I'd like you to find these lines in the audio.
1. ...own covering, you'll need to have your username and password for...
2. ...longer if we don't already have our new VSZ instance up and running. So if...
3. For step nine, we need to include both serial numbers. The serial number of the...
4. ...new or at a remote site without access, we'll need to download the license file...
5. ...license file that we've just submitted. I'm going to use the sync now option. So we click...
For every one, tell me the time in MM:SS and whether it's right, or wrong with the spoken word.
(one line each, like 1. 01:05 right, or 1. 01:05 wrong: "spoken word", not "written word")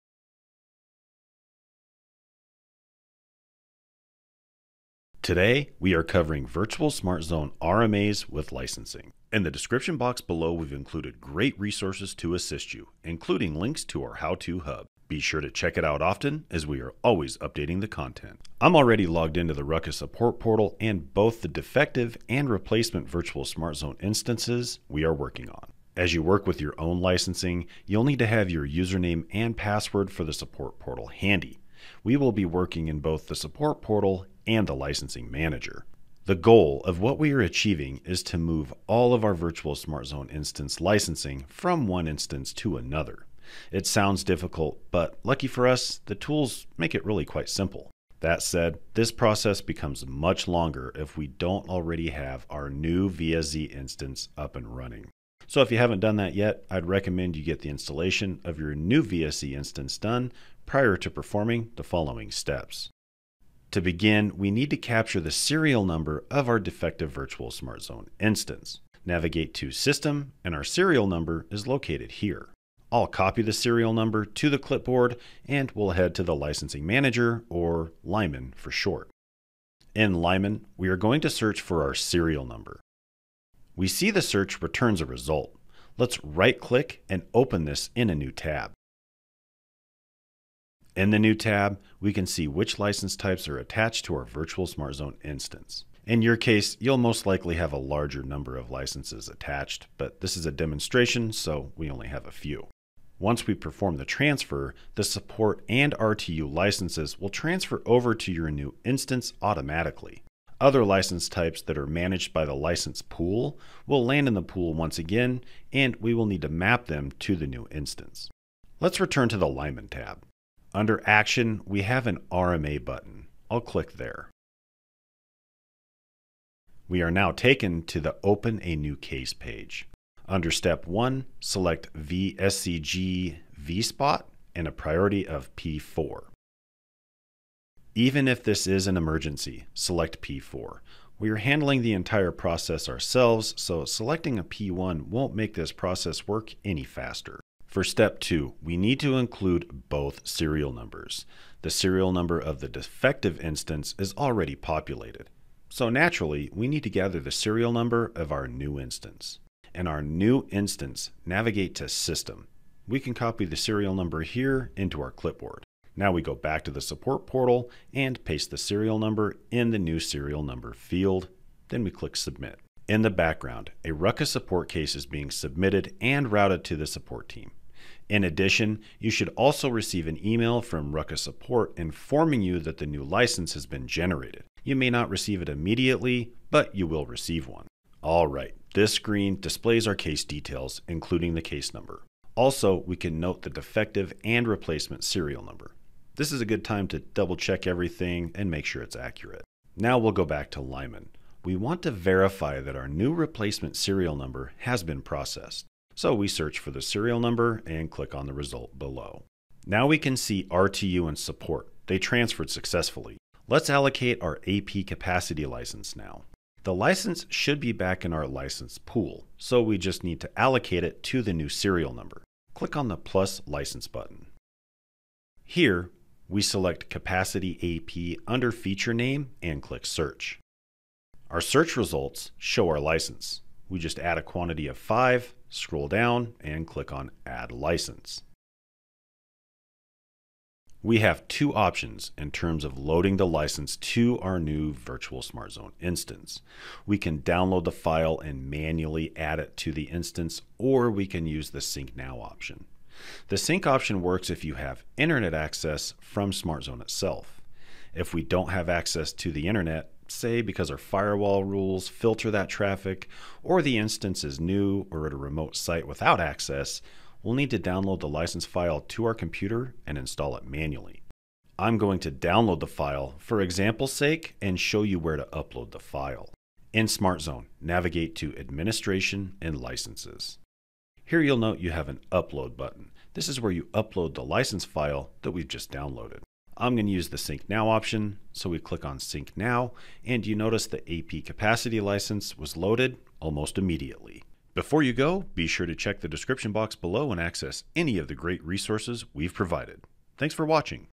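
1. 00:26 wrong: "licensing", not "covering"
2. 00:50 right
3. 02:27 wrong: "two", not "nine"
4. 04:24 right
5. 04:44 wrong: "downloaded", not "submitted".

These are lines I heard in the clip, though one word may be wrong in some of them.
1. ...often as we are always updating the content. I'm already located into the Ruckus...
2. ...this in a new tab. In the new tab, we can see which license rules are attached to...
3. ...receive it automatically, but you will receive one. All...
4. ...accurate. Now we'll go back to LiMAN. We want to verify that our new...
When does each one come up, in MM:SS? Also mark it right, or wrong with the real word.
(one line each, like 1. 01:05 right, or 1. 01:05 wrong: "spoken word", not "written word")
1. 00:16 wrong: "logged", not "located"
2. 01:27 wrong: "types", not "rules"
3. 03:05 wrong: "immediately", not "automatically"
4. 03:18 right.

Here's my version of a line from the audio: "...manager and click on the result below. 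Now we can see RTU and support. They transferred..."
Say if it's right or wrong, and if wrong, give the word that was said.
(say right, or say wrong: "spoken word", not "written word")
wrong: "number", not "manager".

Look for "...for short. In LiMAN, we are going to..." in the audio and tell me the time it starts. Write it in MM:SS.
01:18.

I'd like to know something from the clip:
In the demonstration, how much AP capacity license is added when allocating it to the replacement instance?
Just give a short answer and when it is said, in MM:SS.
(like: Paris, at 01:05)
5, at 03:54.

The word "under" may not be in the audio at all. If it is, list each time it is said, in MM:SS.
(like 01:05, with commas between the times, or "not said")
02:00, 02:10, 03:48.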